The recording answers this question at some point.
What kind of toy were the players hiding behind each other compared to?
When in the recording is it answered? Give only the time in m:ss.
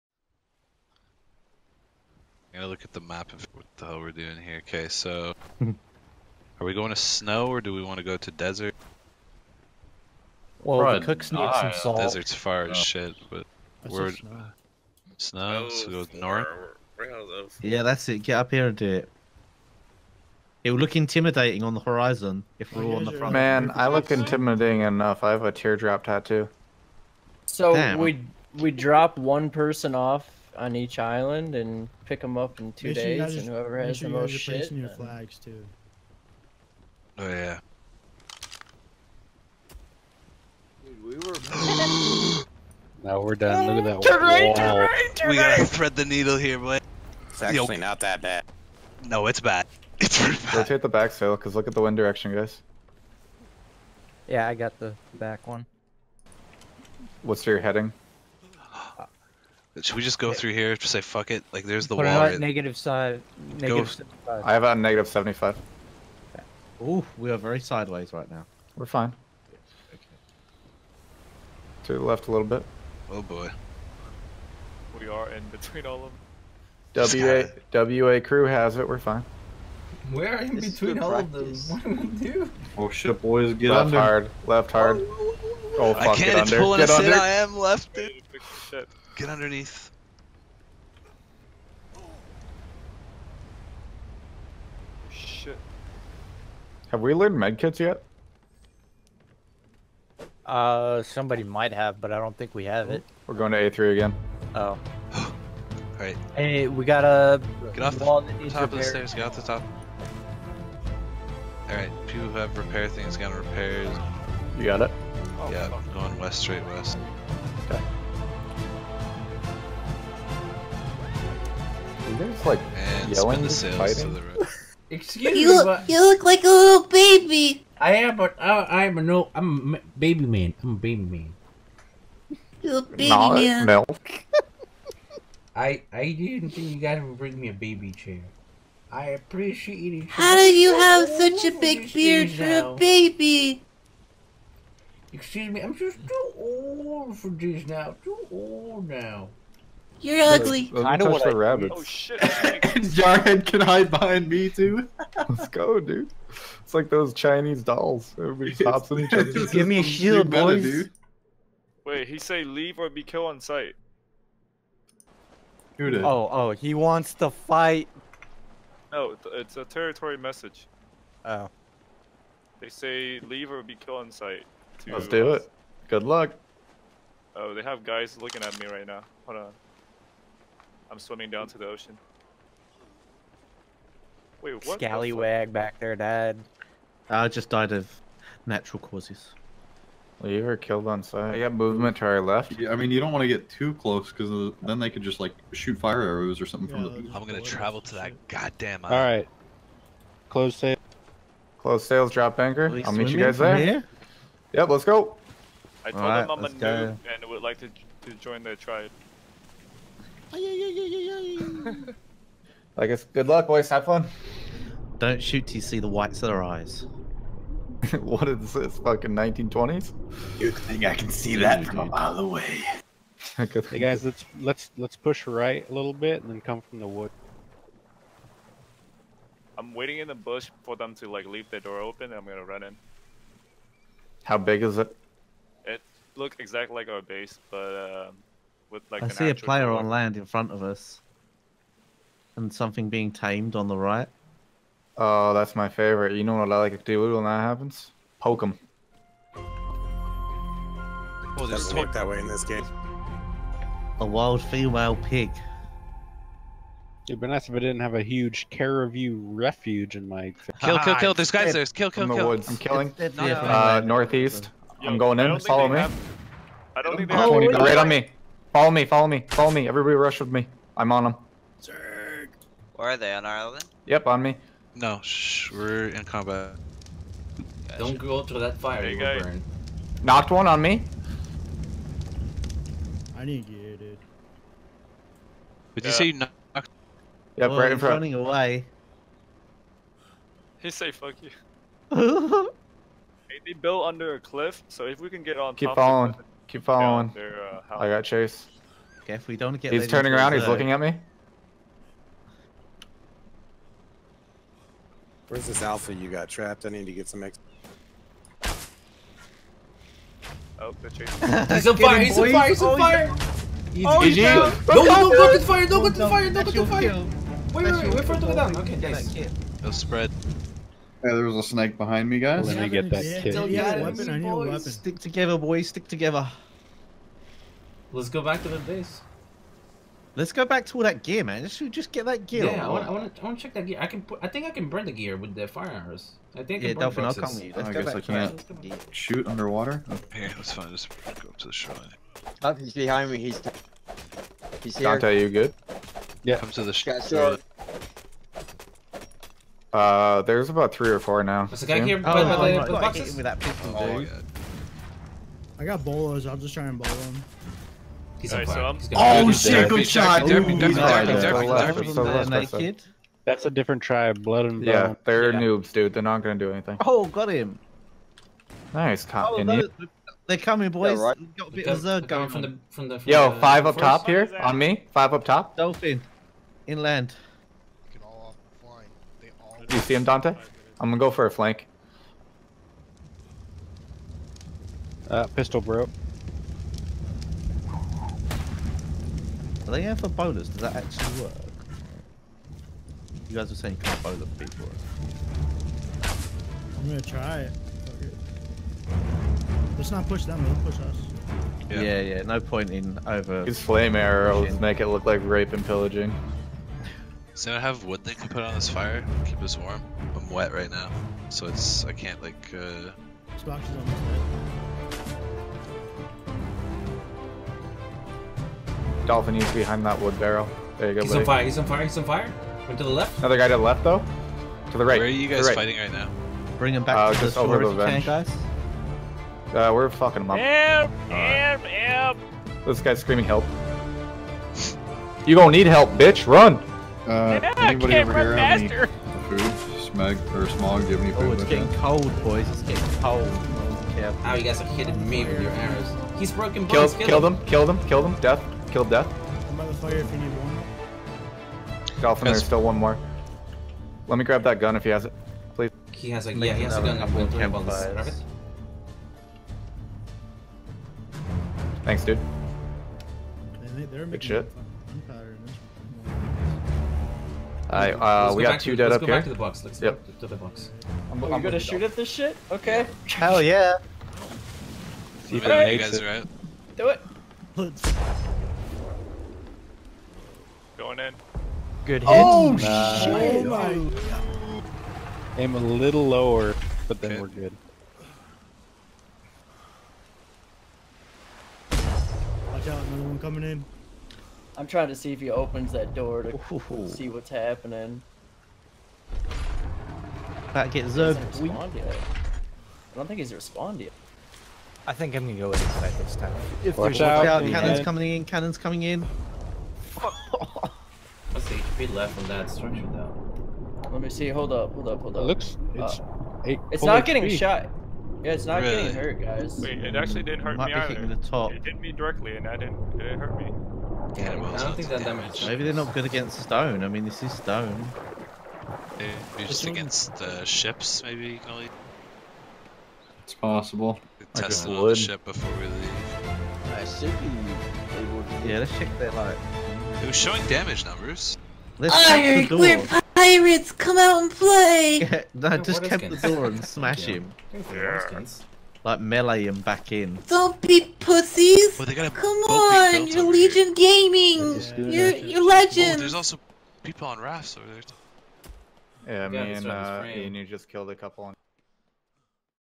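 2:37.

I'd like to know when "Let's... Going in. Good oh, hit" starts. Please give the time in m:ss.
7:57.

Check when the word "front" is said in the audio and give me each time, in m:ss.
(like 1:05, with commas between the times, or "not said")
0:23, 4:00, 4:47.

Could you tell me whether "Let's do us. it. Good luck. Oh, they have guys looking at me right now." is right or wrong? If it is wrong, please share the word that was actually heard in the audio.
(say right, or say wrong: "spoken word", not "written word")
right.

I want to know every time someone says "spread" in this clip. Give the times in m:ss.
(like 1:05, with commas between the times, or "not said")
5:19.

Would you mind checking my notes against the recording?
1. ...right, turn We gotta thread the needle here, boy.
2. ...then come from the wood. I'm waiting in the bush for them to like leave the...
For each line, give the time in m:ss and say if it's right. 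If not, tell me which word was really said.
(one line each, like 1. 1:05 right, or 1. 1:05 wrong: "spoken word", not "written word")
1. 0:44 right
2. 3:46 right.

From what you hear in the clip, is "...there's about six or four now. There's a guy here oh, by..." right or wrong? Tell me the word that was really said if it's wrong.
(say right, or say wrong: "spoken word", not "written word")
wrong: "three", not "six".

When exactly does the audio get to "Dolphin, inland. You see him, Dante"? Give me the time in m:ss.
6:15.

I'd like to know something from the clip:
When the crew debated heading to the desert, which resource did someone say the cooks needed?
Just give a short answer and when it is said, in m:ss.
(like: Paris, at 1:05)
Salt, at 0:11.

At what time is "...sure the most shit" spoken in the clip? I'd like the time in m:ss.
0:33.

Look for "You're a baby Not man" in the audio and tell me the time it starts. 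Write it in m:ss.
2:12.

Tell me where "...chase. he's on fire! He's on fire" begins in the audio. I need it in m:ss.
5:10.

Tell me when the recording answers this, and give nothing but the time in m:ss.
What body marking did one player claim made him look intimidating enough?
0:25.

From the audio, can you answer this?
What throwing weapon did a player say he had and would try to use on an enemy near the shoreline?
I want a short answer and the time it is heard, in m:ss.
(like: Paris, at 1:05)
Bolos, at 5:55.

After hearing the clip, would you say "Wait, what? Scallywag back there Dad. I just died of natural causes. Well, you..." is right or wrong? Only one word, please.
right.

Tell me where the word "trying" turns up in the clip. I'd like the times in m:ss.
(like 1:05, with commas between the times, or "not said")
8:14.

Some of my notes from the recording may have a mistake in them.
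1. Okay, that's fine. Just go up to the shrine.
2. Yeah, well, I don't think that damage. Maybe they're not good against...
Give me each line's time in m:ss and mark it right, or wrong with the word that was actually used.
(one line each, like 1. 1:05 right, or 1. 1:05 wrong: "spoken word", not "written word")
1. 5:39 right
2. 8:44 right.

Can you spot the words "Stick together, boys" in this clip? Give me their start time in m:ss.
5:24.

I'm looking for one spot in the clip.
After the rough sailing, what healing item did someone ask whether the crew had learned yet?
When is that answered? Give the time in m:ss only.
1:37.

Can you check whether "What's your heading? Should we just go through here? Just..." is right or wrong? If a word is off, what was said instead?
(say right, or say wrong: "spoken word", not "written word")
right.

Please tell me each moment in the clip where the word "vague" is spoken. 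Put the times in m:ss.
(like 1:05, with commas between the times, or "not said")
not said.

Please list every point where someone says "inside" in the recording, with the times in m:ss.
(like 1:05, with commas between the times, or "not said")
8:25.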